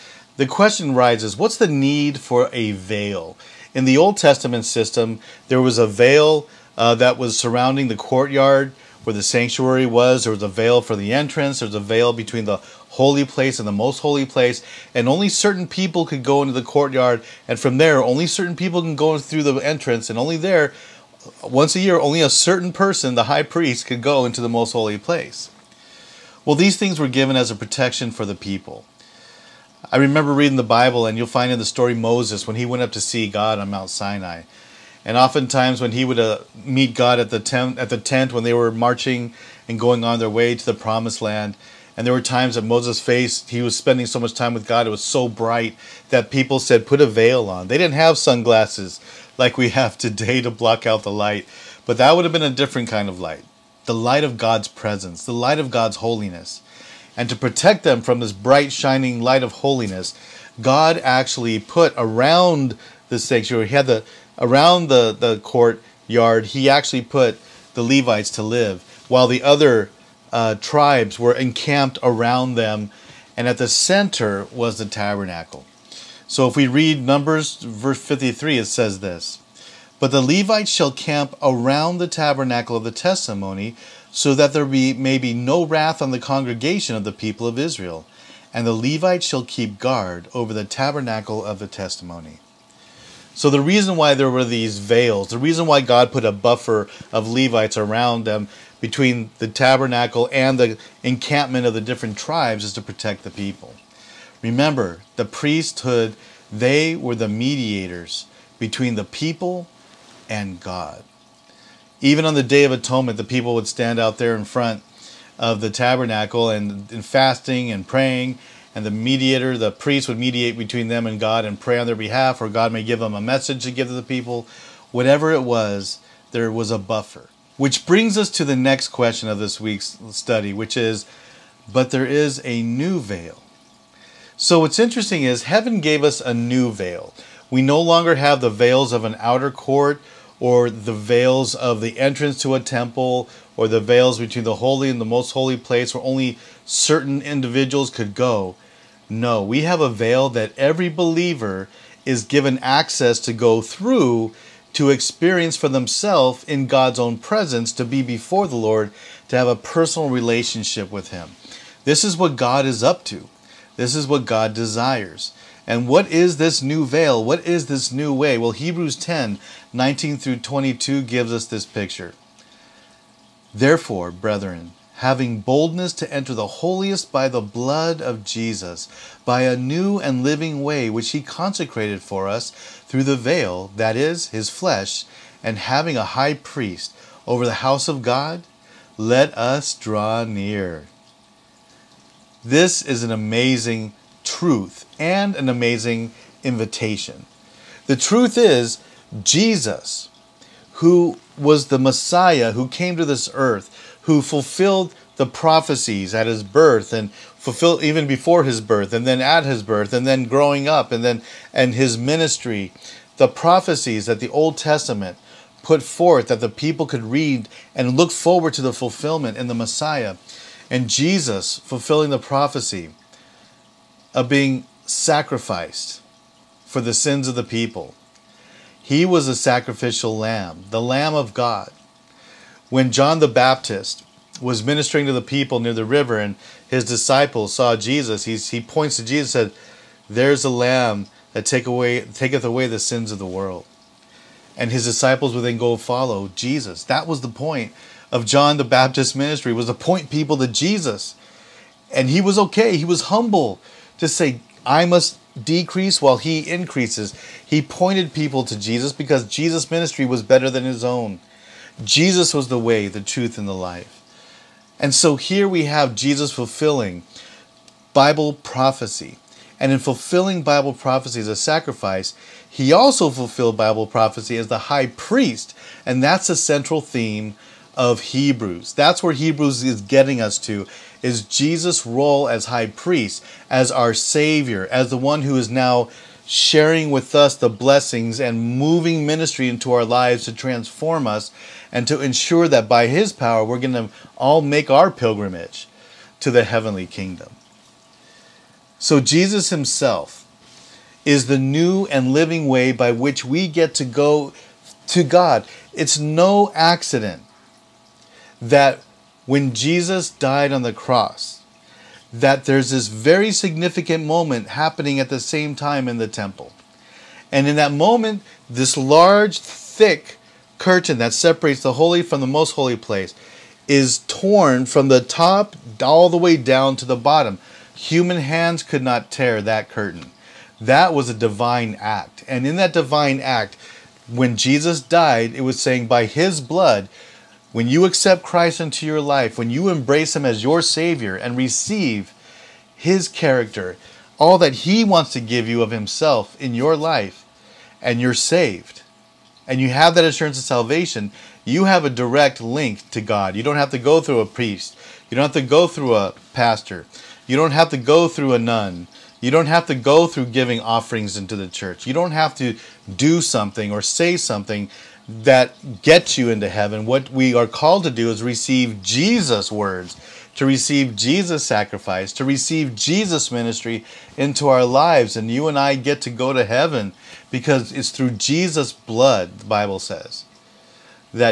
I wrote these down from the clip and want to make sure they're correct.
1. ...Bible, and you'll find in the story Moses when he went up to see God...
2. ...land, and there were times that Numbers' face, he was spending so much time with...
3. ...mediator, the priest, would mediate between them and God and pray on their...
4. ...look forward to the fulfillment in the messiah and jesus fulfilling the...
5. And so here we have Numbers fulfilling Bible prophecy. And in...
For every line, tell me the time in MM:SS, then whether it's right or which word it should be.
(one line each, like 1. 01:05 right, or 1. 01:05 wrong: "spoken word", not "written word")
1. 00:30 right
2. 00:41 wrong: "Moses", not "Numbers"
3. 01:58 right
4. 03:37 right
5. 04:24 wrong: "Jesus", not "Numbers".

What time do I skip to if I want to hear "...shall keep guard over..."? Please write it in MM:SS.
01:29.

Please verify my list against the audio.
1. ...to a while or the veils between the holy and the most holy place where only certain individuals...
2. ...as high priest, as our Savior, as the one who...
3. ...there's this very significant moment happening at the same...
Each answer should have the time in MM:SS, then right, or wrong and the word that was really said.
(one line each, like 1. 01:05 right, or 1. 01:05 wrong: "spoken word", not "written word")
1. 02:22 wrong: "temple", not "while"
2. 04:42 right
3. 05:12 right.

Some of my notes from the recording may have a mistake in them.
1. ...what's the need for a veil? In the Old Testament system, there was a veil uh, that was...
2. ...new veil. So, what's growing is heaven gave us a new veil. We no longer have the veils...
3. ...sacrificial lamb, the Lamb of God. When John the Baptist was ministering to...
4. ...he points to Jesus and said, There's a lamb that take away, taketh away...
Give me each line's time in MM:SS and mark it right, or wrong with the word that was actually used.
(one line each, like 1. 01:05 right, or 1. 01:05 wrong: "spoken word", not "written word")
1. 00:01 right
2. 02:12 wrong: "interesting", not "growing"
3. 03:49 right
4. 03:58 right.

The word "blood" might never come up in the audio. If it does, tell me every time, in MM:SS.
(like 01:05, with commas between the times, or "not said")
02:57, 05:36, 06:18.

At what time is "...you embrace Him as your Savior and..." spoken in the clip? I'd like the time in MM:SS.
05:39.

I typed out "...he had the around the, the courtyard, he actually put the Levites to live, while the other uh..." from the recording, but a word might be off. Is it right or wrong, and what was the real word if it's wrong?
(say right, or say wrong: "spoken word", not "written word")
right.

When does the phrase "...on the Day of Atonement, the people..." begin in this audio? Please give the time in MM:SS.
01:52.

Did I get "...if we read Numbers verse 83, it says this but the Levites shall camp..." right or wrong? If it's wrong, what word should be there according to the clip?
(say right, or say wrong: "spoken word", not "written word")
wrong: "53", not "83".